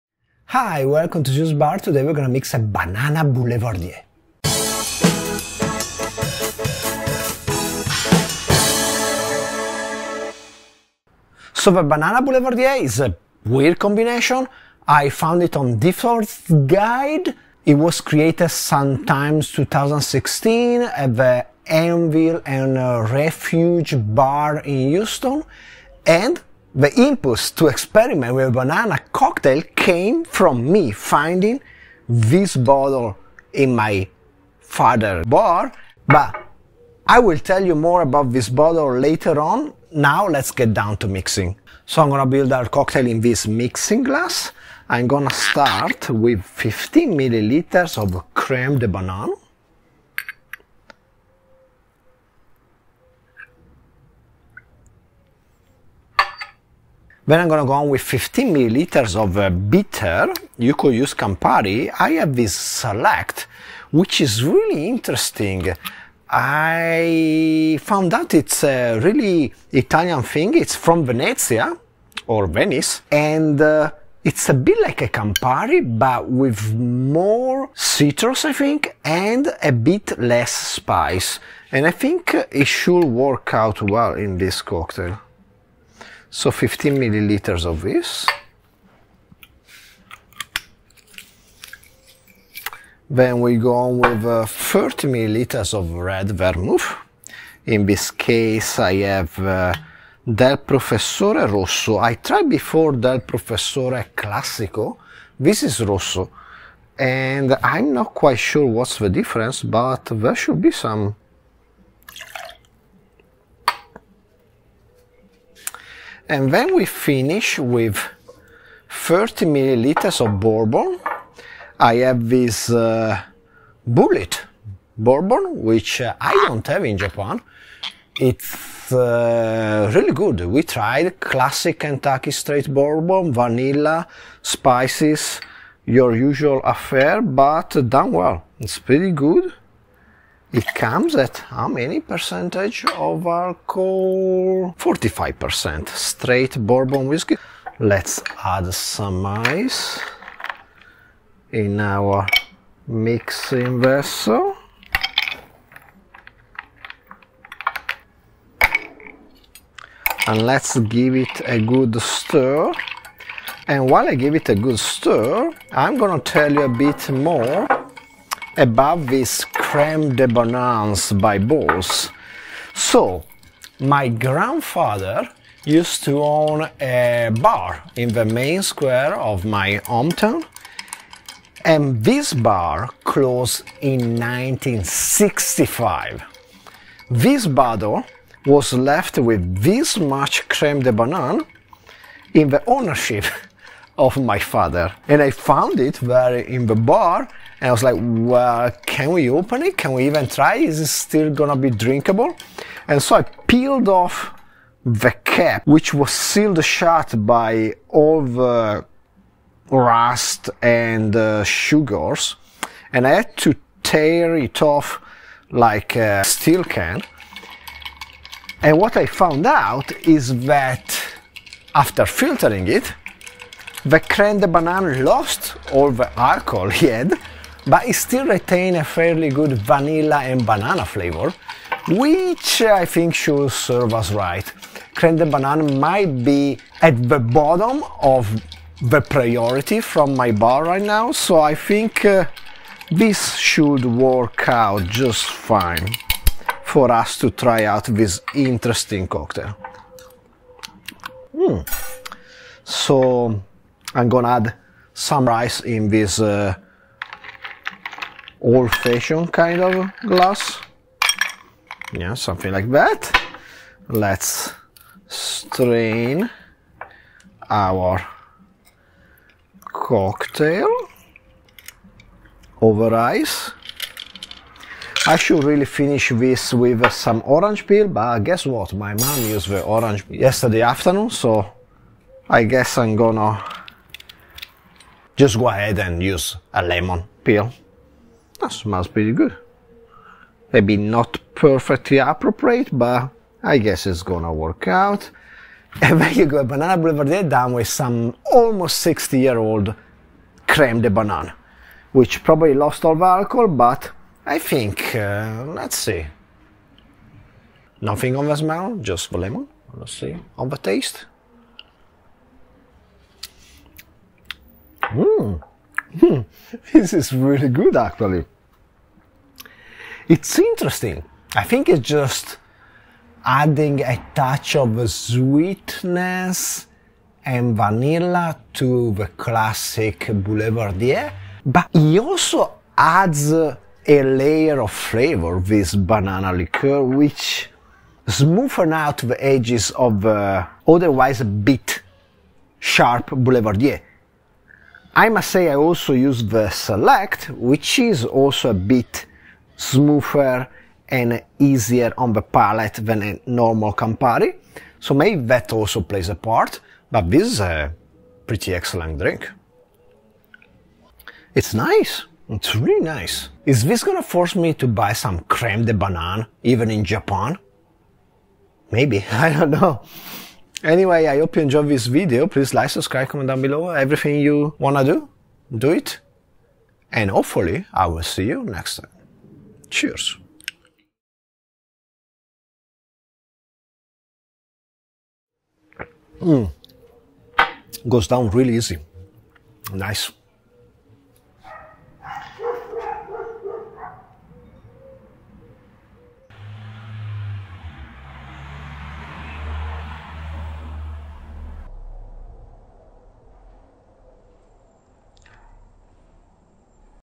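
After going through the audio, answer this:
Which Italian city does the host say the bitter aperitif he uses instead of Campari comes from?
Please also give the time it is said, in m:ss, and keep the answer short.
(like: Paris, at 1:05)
Venice, at 1:12.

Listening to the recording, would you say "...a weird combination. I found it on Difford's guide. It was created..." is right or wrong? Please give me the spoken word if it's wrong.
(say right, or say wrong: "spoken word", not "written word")
right.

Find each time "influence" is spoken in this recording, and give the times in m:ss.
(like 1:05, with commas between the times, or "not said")
not said.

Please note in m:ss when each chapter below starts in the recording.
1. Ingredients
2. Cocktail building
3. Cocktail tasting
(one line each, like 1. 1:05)
1. 6:23
2. 0:41
3. 4:55.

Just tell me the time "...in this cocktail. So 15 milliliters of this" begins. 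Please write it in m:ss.
1:24.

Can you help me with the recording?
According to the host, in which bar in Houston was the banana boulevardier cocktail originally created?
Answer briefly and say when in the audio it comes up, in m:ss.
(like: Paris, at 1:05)
Anvil and Refuge, at 0:21.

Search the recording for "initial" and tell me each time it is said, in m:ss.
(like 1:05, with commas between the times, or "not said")
not said.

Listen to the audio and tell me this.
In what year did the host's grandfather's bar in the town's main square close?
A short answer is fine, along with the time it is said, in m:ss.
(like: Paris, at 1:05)
1965, at 3:04.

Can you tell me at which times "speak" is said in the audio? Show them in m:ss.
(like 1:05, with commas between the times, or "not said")
not said.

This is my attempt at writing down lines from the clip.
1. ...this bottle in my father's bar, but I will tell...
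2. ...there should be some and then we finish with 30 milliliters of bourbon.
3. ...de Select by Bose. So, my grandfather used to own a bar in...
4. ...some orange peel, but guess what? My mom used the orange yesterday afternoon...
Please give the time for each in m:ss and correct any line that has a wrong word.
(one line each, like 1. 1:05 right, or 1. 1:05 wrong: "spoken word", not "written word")
1. 0:32 right
2. 1:50 right
3. 2:50 wrong: "Bananes", not "Select"
4. 4:36 right.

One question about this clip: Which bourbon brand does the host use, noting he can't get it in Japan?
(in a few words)
Bulleit.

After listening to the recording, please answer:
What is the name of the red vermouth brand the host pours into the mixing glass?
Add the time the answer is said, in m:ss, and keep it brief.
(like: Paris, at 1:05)
Del Professore Rosso, at 1:40.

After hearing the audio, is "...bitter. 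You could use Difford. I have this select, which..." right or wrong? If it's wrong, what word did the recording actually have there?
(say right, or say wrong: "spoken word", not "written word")
wrong: "Campari", not "Difford".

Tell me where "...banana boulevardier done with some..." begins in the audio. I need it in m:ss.
4:56.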